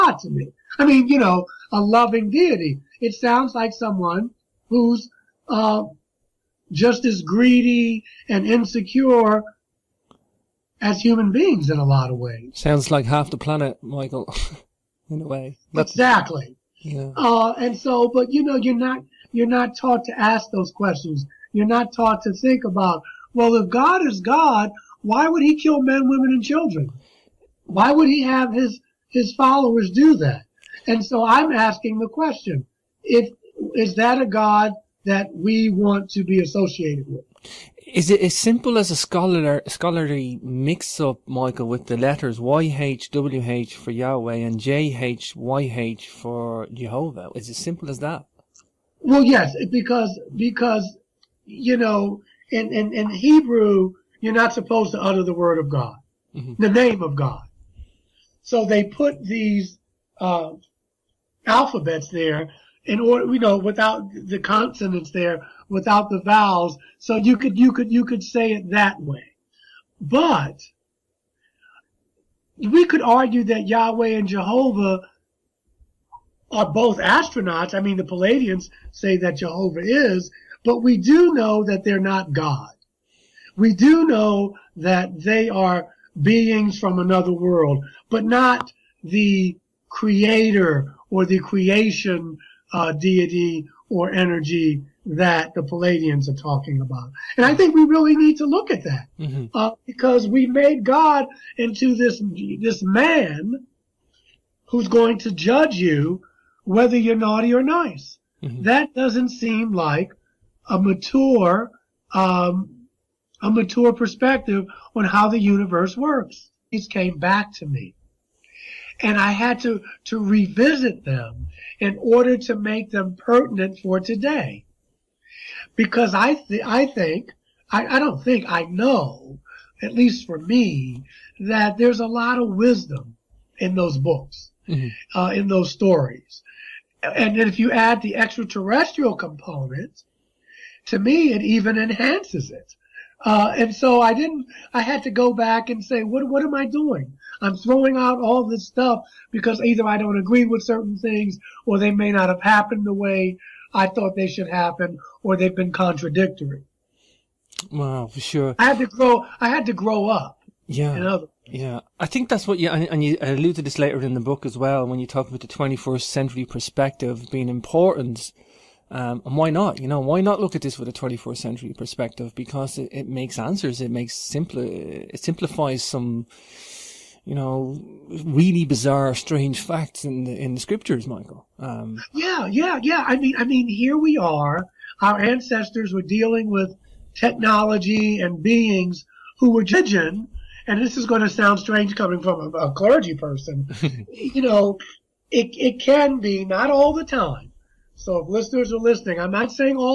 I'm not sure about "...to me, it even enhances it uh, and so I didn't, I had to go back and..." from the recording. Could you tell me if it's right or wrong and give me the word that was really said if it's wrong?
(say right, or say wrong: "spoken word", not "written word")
right.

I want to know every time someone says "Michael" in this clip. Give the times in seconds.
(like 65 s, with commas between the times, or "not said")
13 s, 41 s, 181 s.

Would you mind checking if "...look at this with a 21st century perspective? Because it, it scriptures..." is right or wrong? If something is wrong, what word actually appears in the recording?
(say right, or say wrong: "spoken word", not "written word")
wrong: "makes", not "scriptures".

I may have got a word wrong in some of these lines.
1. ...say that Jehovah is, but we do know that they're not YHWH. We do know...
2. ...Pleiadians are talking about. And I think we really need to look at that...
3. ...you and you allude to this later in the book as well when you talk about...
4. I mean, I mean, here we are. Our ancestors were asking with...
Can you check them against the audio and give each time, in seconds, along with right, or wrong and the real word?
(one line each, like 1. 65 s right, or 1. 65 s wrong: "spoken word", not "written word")
1. 78 s wrong: "God", not "YHWH"
2. 95 s right
3. 162 s right
4. 183 s wrong: "dealing", not "asking".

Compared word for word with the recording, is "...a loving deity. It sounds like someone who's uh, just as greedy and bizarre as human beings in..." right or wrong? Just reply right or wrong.
wrong.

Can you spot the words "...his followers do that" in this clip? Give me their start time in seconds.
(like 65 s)
29 s.